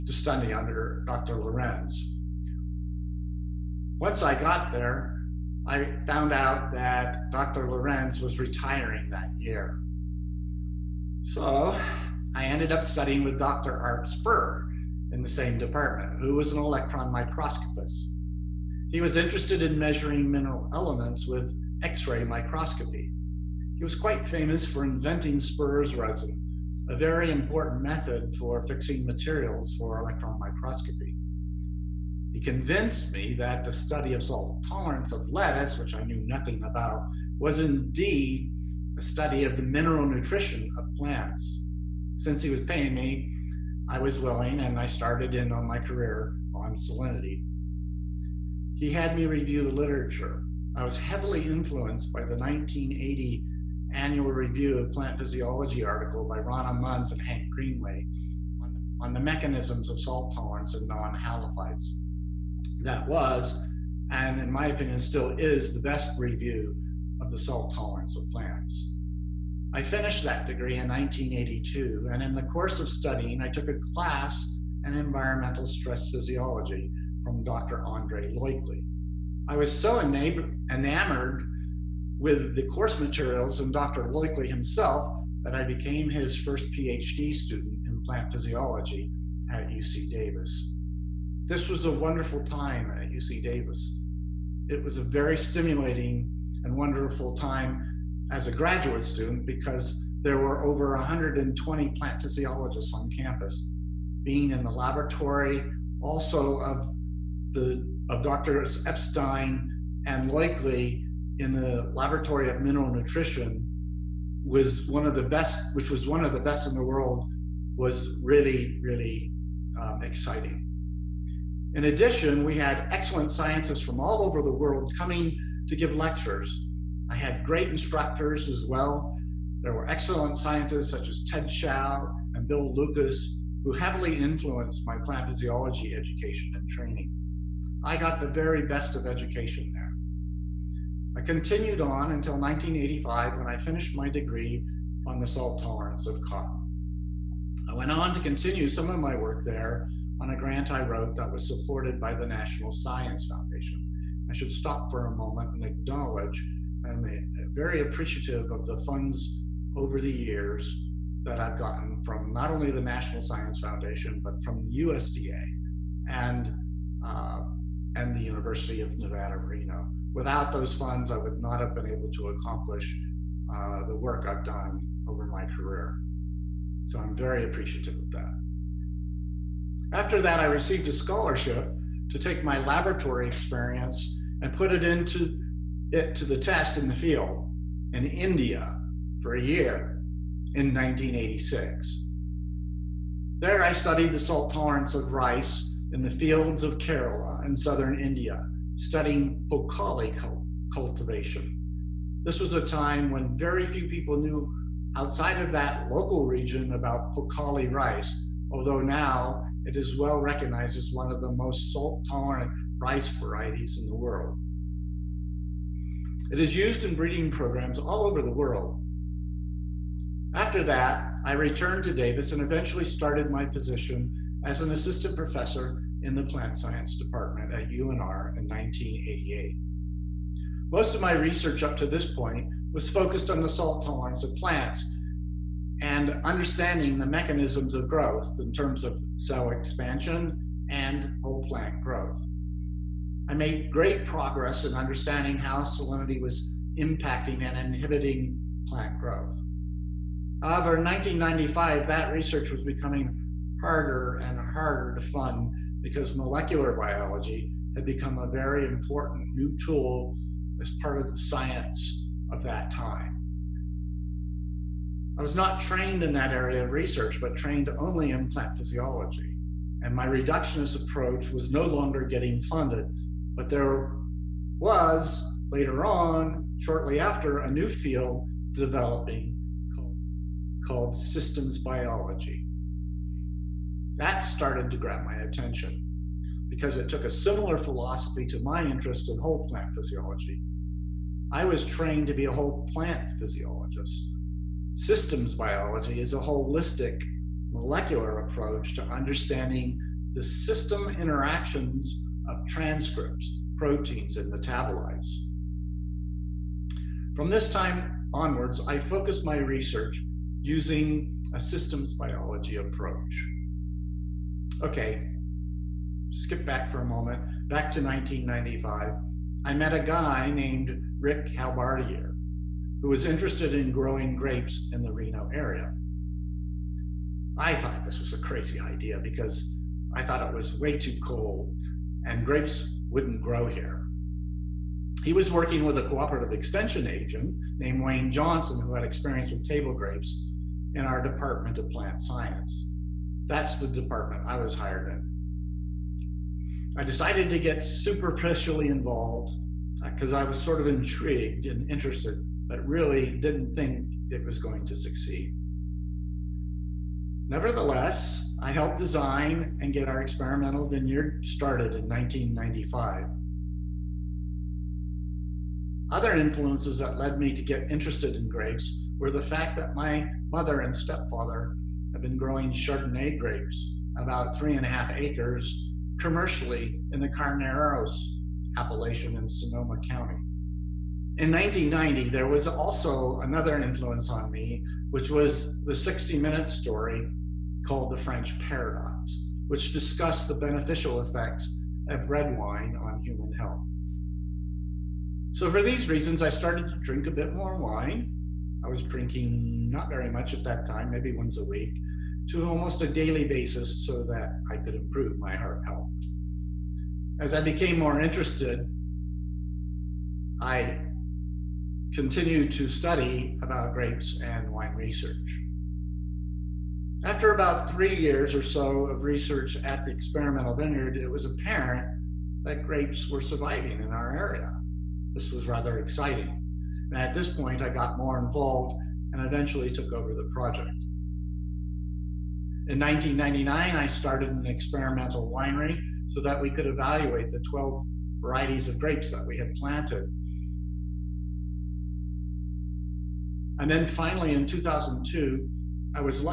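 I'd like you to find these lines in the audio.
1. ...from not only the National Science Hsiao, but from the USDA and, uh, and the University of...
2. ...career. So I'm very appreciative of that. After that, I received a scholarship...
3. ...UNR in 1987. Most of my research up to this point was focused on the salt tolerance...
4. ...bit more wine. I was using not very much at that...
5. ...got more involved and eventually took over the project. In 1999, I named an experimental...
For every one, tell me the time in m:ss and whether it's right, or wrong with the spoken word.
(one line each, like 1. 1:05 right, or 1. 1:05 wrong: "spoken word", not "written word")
1. 2:42 wrong: "Foundation", not "Hsiao"
2. 2:55 right
3. 3:47 wrong: "1988", not "1987"
4. 6:37 wrong: "drinking", not "using"
5. 7:07 wrong: "started", not "named".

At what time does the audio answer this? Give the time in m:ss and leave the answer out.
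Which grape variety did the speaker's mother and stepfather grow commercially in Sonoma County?
6:12.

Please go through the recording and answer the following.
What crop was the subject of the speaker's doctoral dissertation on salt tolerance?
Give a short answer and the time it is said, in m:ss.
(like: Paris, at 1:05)
Cotton, at 2:26.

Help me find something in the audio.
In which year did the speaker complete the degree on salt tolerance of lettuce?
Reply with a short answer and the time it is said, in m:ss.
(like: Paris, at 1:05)
1982, at 1:10.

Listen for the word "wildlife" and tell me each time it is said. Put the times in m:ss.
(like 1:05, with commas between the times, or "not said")
not said.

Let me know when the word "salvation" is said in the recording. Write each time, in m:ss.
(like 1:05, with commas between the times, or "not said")
not said.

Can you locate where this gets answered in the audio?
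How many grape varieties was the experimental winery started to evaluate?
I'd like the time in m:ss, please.
7:17.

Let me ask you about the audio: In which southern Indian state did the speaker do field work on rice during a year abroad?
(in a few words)
Kerala.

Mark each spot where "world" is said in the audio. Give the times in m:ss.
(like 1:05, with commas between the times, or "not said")
1:56, 2:04, 3:33, 3:38.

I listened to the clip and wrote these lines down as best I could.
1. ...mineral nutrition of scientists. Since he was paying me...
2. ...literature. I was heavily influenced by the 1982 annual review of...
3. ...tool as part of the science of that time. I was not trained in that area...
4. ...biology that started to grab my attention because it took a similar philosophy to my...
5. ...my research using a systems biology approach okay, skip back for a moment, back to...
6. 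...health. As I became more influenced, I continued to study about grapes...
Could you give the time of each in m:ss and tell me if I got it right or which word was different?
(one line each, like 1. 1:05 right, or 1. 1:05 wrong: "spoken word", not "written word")
1. 0:39 wrong: "plants", not "scientists"
2. 0:49 wrong: "1980", not "1982"
3. 4:19 right
4. 4:41 right
5. 5:09 right
6. 6:45 wrong: "interested", not "influenced".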